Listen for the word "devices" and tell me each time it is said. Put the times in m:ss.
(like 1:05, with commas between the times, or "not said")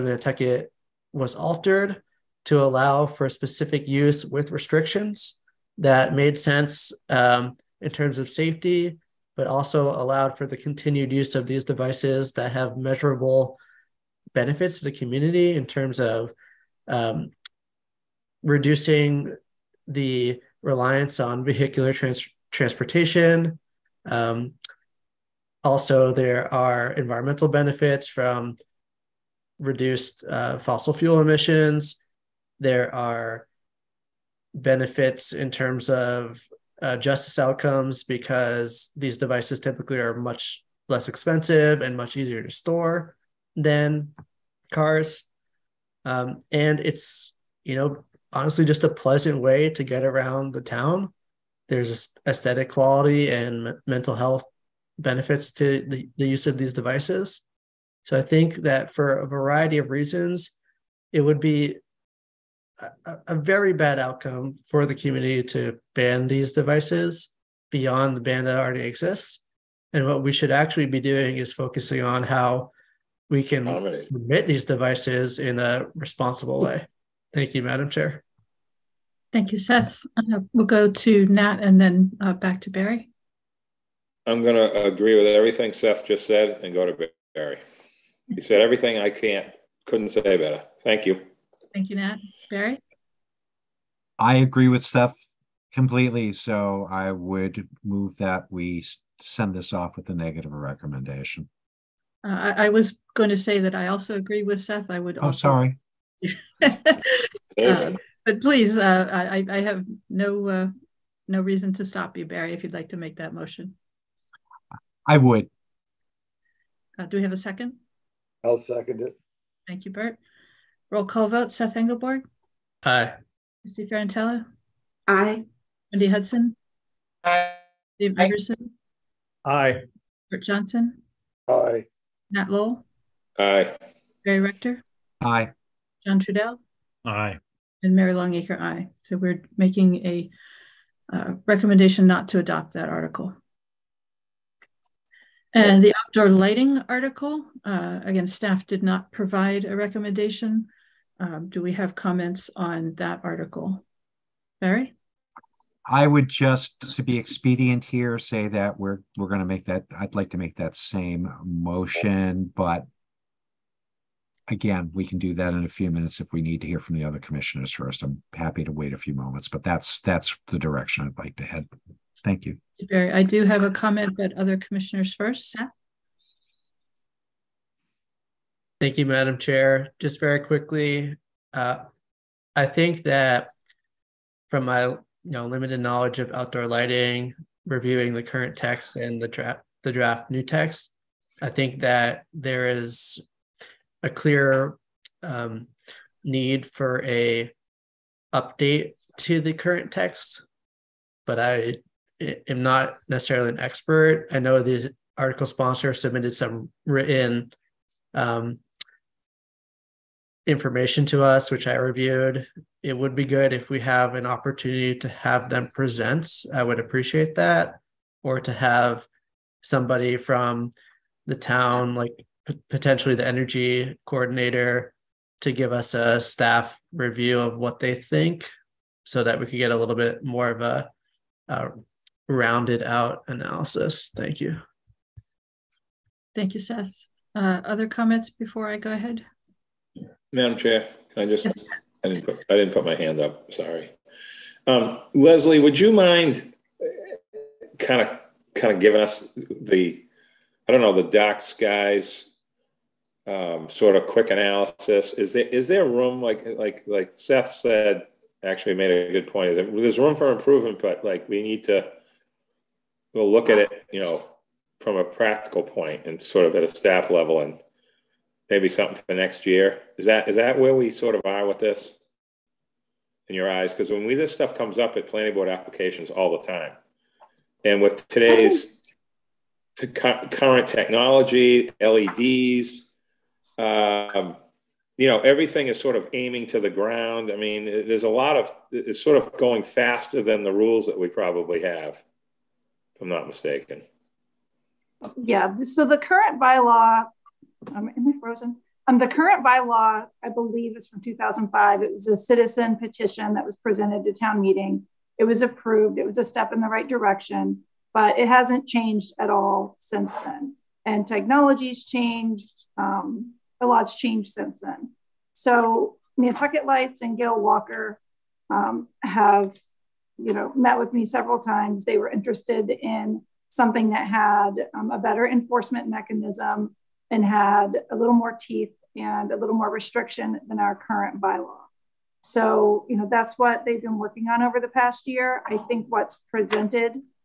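0:11, 0:39, 0:56, 1:06, 1:14.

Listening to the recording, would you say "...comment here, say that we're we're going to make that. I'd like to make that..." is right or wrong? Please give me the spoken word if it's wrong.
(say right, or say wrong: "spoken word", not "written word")
wrong: "expedient", not "comment".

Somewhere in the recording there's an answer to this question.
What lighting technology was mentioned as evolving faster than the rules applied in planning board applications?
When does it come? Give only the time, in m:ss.
4:41.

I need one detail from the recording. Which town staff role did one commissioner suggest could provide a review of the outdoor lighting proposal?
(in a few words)
energy coordinator.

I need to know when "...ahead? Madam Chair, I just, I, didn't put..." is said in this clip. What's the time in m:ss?
3:58.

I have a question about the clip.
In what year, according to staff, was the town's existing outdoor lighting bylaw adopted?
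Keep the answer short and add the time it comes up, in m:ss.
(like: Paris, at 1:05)
2005, at 5:01.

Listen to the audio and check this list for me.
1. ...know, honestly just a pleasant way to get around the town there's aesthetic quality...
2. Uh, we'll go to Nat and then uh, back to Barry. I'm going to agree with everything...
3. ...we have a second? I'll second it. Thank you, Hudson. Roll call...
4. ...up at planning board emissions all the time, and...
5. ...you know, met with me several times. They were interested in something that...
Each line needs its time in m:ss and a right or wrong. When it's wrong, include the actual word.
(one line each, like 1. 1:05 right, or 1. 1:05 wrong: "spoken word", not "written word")
1. 0:47 right
2. 1:20 right
3. 1:57 wrong: "Bert", not "Hudson"
4. 4:34 wrong: "applications", not "emissions"
5. 5:20 right.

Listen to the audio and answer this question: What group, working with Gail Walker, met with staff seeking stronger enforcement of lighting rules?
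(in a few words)
Nantucket Lights.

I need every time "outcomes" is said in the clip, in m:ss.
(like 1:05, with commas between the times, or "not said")
0:37, 1:03.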